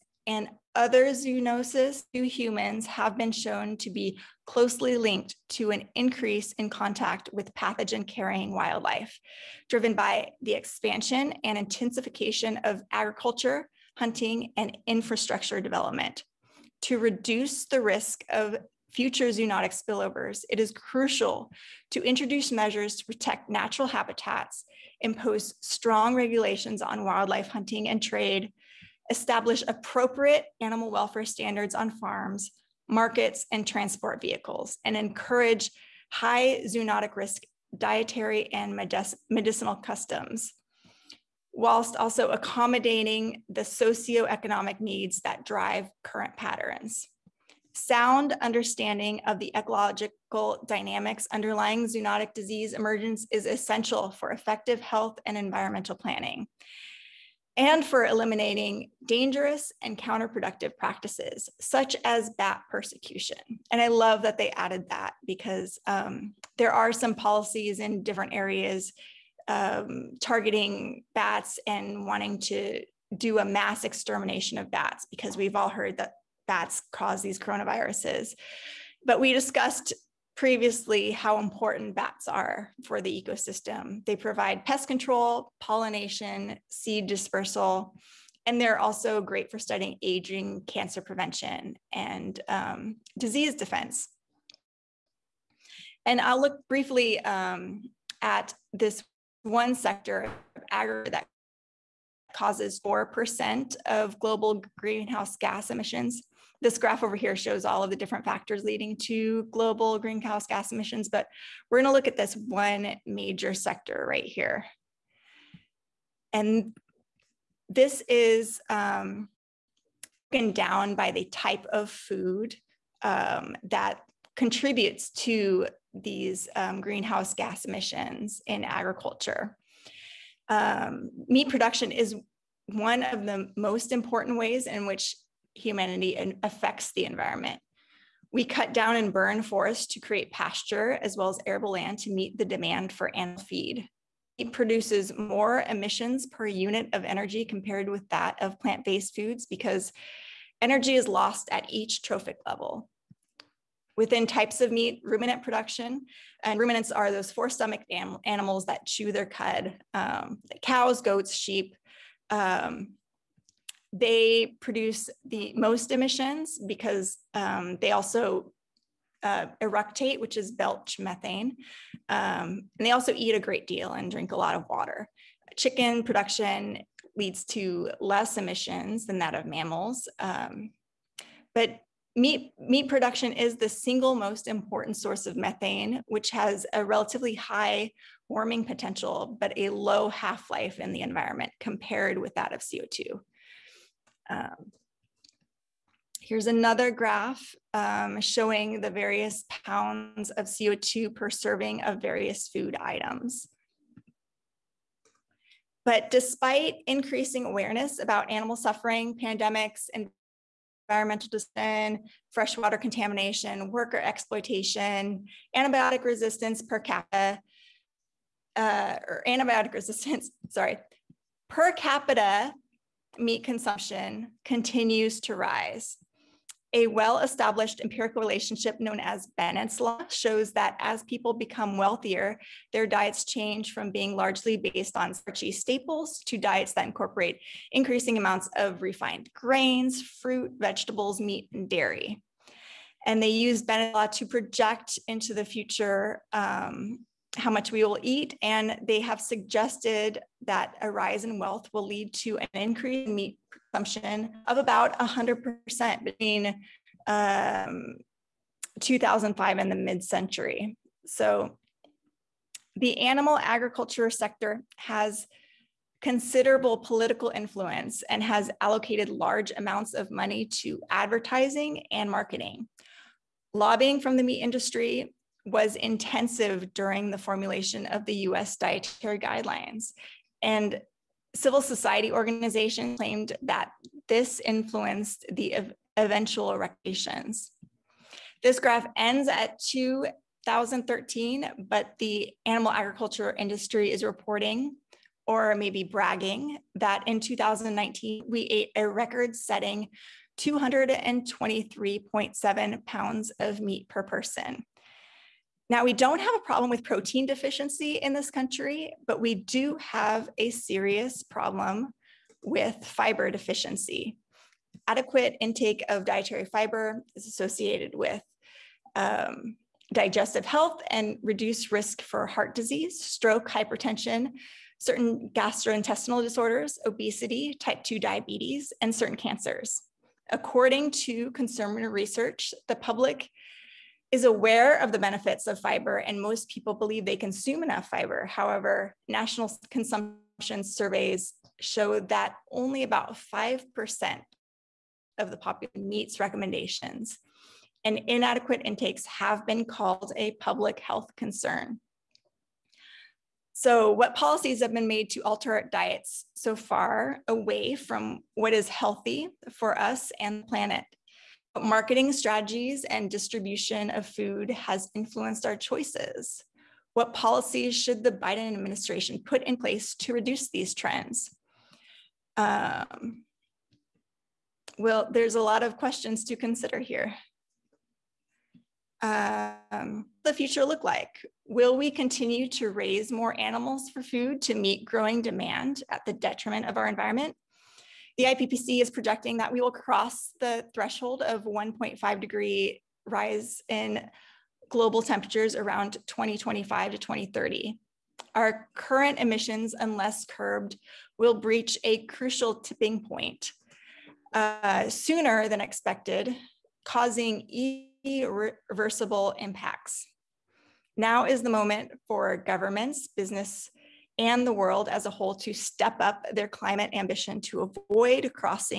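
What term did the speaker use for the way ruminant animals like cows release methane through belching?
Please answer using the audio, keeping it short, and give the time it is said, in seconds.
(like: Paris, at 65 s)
eructate, at 169 s.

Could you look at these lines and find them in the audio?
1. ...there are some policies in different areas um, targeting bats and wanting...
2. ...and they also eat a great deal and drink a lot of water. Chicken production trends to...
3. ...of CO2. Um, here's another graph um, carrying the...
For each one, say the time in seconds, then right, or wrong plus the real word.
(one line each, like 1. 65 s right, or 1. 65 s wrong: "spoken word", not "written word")
1. 66 s right
2. 172 s wrong: "leads", not "trends"
3. 192 s wrong: "showing", not "carrying".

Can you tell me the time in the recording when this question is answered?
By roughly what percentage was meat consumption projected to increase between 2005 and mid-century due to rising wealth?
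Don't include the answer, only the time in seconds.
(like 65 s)
254 s.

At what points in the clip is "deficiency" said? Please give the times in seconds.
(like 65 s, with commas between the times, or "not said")
307 s, 313 s.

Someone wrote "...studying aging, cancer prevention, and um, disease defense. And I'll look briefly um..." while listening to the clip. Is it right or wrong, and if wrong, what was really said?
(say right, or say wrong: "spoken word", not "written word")
right.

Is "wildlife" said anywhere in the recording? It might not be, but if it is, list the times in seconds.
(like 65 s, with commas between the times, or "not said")
8 s, 27 s.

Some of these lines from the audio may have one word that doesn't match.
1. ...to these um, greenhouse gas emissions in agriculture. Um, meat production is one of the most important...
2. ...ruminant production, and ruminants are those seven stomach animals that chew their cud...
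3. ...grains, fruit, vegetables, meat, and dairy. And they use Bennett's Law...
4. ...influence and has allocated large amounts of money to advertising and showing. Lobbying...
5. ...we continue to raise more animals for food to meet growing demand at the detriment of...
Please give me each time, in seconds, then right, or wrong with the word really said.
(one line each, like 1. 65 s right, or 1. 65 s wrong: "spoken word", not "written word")
1. 125 s right
2. 155 s wrong: "four", not "seven"
3. 239 s right
4. 267 s wrong: "marketing", not "showing"
5. 381 s right.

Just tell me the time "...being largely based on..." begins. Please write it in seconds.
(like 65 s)
233 s.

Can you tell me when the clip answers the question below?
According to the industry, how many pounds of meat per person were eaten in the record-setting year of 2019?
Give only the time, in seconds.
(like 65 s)
300 s.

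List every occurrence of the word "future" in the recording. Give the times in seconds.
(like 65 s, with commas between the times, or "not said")
18 s, 245 s, 380 s.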